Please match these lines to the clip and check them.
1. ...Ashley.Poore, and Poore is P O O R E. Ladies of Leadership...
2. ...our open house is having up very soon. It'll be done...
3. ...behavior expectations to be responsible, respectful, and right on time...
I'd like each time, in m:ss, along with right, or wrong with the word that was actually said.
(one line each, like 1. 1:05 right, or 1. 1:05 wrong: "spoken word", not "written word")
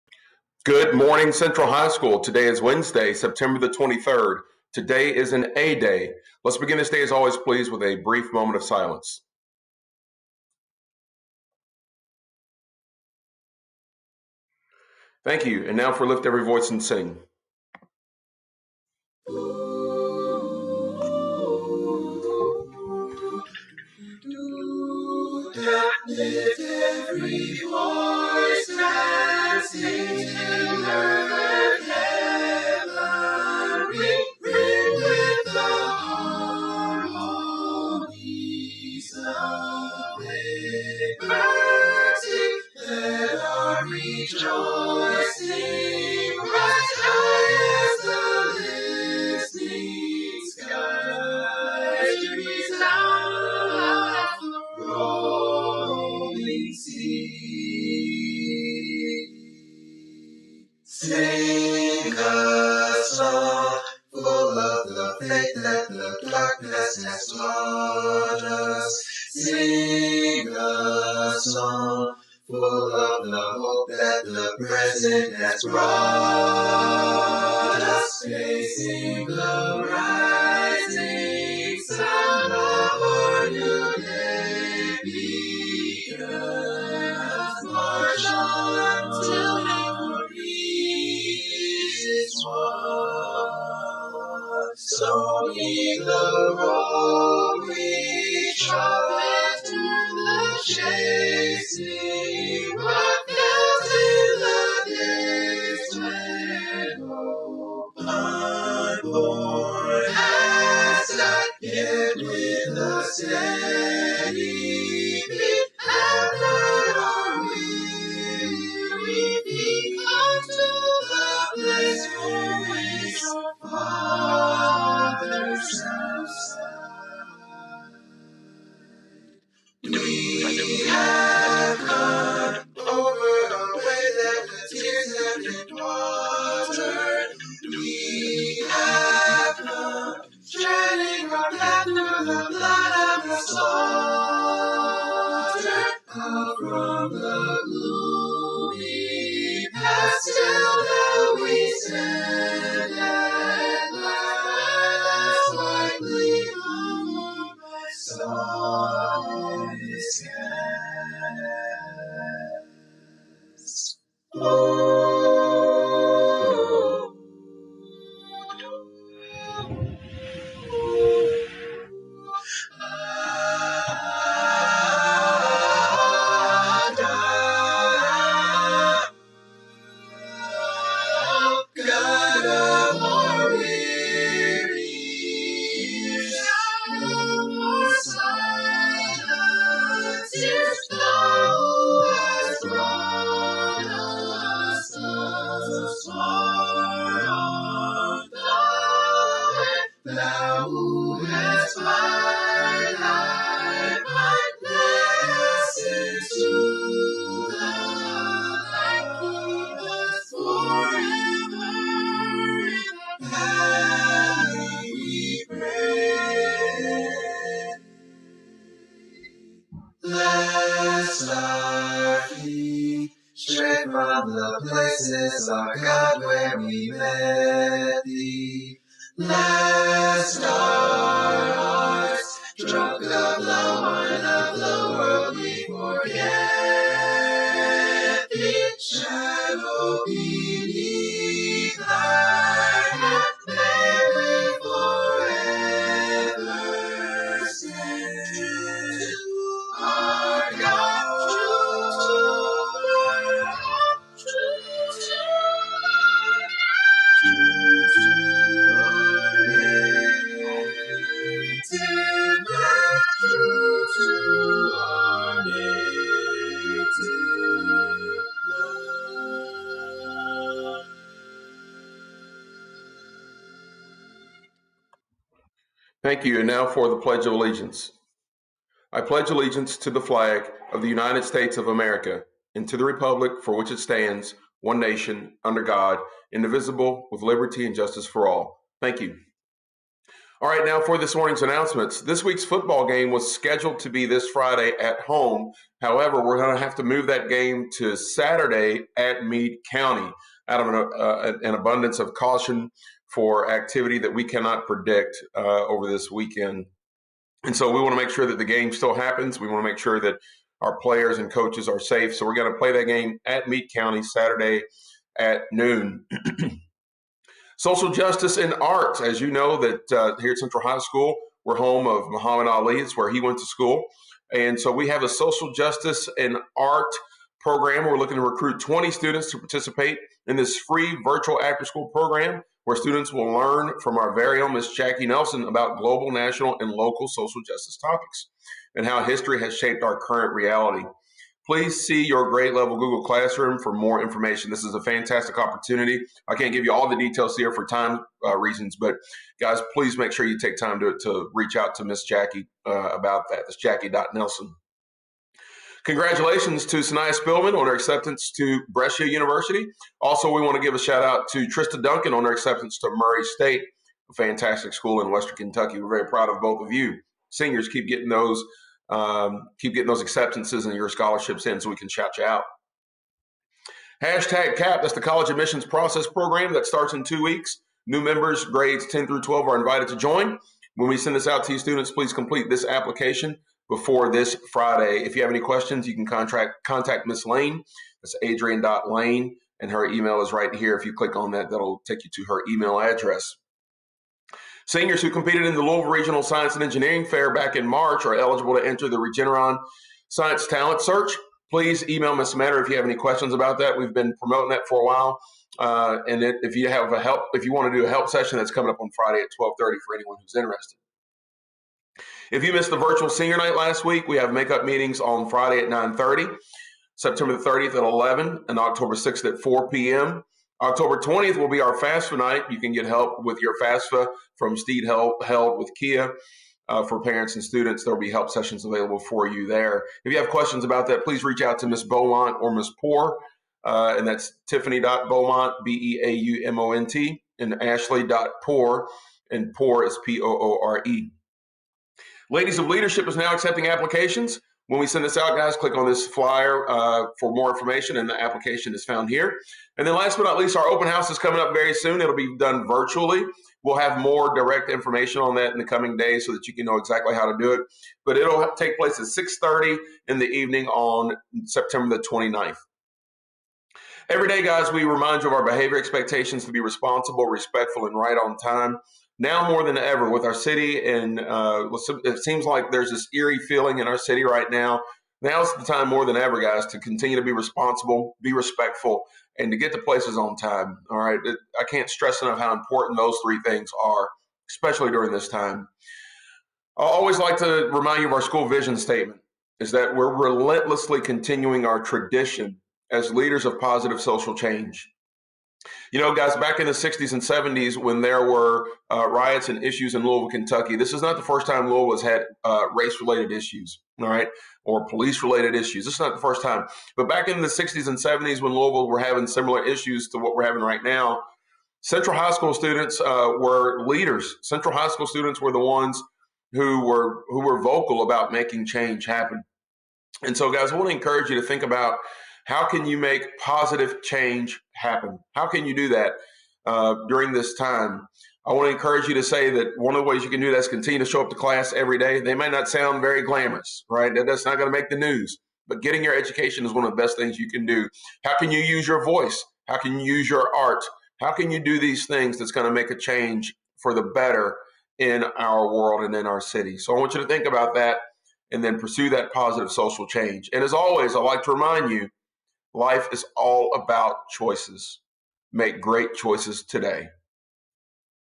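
1. 7:17 right
2. 7:30 wrong: "coming", not "having"
3. 7:45 right.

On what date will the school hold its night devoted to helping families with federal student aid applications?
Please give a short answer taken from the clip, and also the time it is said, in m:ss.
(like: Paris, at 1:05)
October 20, at 7:00.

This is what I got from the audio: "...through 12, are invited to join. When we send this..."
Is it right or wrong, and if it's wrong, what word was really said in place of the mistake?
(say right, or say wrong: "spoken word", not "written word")
right.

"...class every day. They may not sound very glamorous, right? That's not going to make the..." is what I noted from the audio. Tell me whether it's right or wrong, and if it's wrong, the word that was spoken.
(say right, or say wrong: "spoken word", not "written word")
right.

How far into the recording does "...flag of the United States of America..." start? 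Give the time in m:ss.
4:40.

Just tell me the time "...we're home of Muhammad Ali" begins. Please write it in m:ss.
5:21.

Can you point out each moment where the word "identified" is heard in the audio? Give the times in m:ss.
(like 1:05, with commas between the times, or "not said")
not said.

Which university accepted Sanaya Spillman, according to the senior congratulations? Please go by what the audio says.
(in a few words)
Brescia University.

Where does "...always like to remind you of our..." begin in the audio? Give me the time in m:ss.
8:06.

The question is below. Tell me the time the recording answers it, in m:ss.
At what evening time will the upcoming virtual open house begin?
7:39.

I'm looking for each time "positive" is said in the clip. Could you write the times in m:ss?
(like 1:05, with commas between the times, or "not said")
8:13, 8:43, 9:09.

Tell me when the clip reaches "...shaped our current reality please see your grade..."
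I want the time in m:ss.
5:39.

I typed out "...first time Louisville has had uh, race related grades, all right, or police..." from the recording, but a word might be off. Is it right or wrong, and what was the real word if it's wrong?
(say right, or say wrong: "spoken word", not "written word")
wrong: "issues", not "grades".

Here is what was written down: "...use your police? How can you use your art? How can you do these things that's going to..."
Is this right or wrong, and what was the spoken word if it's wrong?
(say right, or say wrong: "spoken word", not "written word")
wrong: "voice", not "police".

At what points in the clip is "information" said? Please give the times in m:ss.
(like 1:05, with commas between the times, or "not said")
5:44, 7:27, 7:34.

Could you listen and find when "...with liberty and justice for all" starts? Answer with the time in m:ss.
4:47.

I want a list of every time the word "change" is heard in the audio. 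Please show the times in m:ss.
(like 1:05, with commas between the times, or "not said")
8:14, 8:38, 8:44, 9:02, 9:10.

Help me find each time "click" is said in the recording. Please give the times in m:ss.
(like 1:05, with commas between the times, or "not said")
6:30, 7:25.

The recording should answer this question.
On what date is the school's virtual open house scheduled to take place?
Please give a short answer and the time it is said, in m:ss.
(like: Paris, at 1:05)
September 29, at 7:41.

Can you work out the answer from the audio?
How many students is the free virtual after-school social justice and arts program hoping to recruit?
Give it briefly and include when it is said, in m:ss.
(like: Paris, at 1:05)
20, at 5:28.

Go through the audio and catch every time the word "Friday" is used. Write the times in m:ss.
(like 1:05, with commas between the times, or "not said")
4:54, 6:24, 6:48, 6:55.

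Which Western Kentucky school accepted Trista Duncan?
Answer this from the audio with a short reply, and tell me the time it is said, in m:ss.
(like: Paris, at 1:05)
Murray State, at 6:02.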